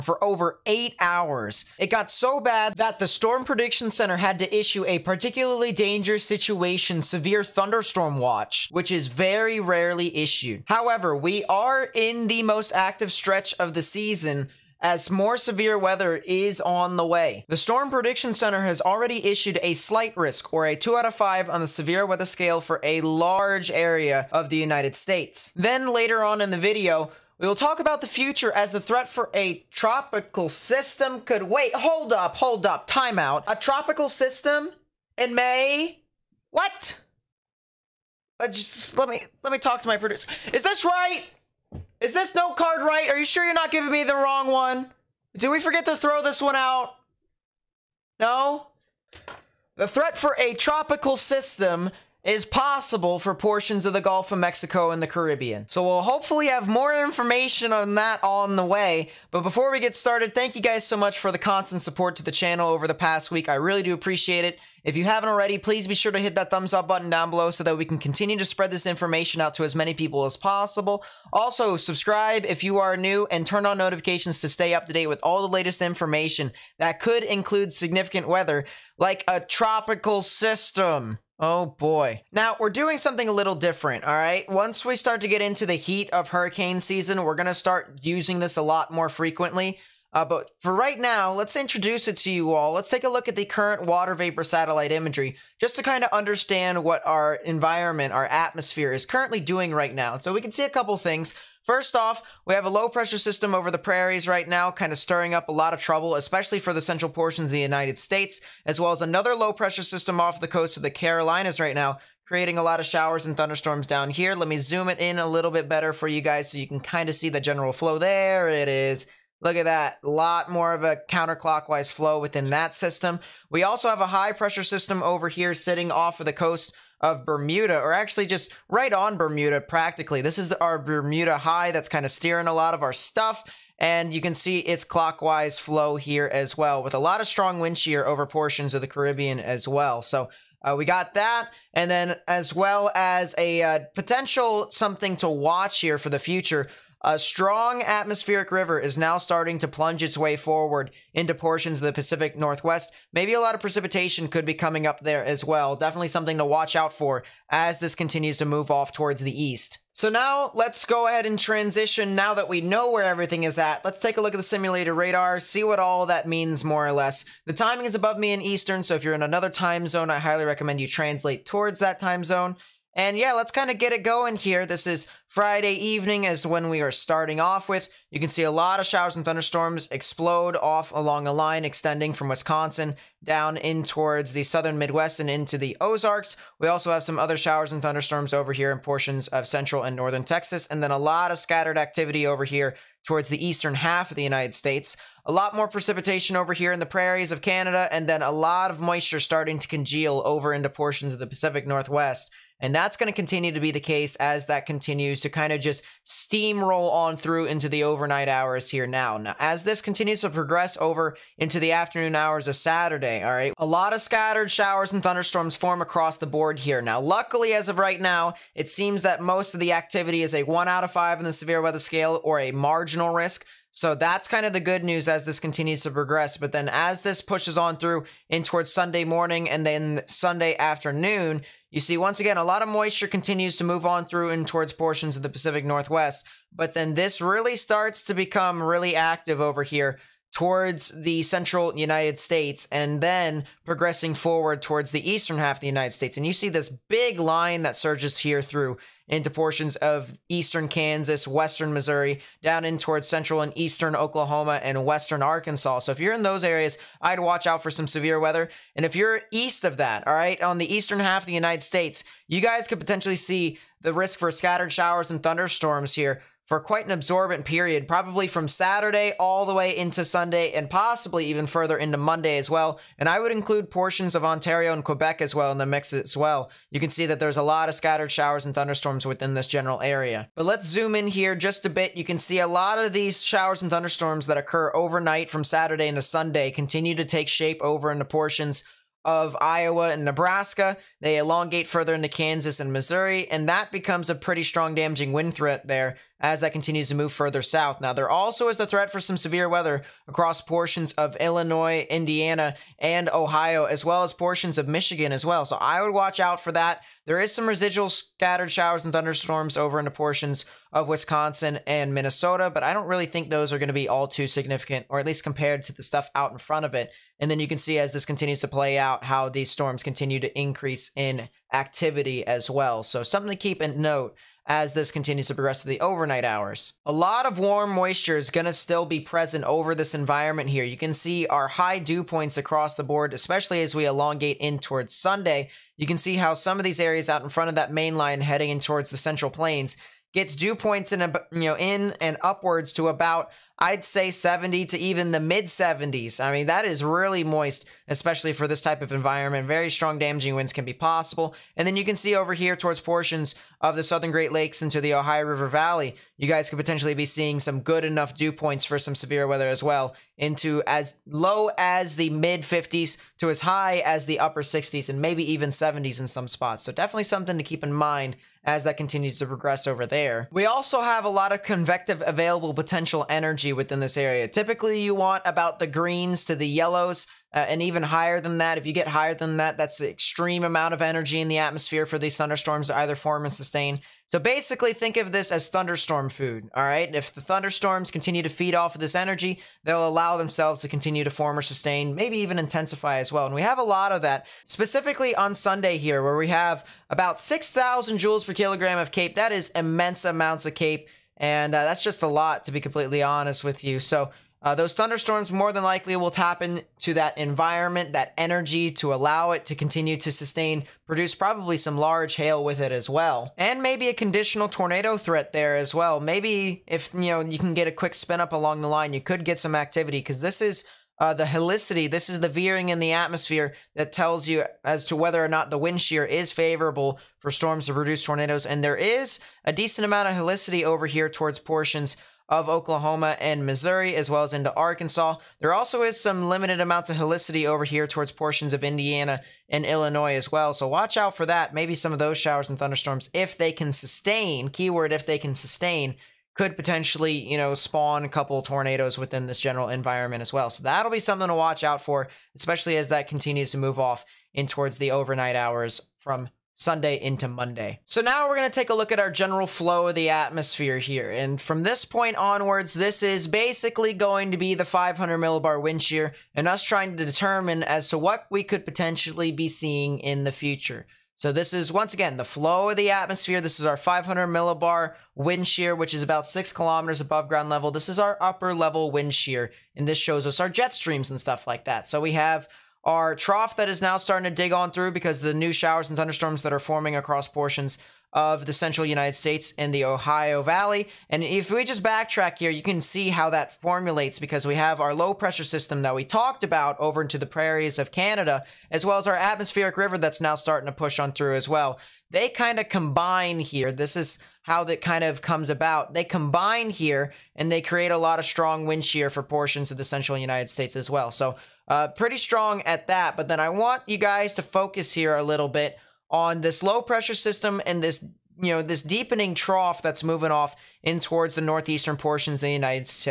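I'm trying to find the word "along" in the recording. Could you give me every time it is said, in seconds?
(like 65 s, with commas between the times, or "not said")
180 s, 418 s.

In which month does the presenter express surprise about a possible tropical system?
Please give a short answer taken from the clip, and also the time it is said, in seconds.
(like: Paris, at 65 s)
May, at 35 s.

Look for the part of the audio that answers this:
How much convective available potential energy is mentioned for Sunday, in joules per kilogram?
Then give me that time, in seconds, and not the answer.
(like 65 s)
397 s.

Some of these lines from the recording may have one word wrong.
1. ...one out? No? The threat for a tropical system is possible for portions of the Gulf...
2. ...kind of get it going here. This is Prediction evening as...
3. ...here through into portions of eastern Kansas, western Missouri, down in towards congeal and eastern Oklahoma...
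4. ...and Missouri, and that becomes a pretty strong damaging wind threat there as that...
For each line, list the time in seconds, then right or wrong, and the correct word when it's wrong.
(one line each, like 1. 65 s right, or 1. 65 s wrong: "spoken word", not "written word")
1. 46 s right
2. 173 s wrong: "Friday", not "Prediction"
3. 248 s wrong: "central", not "congeal"
4. 292 s right.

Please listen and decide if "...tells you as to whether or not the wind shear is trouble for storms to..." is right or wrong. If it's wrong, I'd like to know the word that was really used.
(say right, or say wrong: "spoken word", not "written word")
wrong: "favorable", not "trouble".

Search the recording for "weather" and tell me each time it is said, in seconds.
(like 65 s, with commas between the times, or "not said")
15 s, 22 s, 78 s, 221 s, 258 s, 299 s, 359 s.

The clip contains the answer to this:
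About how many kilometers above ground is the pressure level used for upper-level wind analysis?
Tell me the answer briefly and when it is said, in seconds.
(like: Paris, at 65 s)
6 kilometers, at 476 s.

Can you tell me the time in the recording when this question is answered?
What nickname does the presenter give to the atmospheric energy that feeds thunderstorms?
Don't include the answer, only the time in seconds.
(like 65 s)
385 s.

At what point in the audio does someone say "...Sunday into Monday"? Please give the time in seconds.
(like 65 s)
456 s.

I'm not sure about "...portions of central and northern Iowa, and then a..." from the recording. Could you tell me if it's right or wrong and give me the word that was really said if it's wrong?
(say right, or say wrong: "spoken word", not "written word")
wrong: "Texas", not "Iowa".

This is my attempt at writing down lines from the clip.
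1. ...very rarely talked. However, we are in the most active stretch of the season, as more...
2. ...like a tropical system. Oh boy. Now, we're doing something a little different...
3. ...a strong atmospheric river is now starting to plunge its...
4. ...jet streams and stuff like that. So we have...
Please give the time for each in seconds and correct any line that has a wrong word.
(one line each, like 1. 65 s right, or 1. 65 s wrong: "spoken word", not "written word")
1. 9 s wrong: "issued", not "talked"
2. 78 s right
3. 147 s right
4. 480 s right.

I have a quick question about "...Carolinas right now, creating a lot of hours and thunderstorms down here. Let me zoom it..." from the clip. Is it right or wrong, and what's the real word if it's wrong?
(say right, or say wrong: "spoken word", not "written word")
wrong: "showers", not "hours".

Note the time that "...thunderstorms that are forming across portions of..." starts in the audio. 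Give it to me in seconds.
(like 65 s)
485 s.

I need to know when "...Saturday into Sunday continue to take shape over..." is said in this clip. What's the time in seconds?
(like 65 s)
285 s.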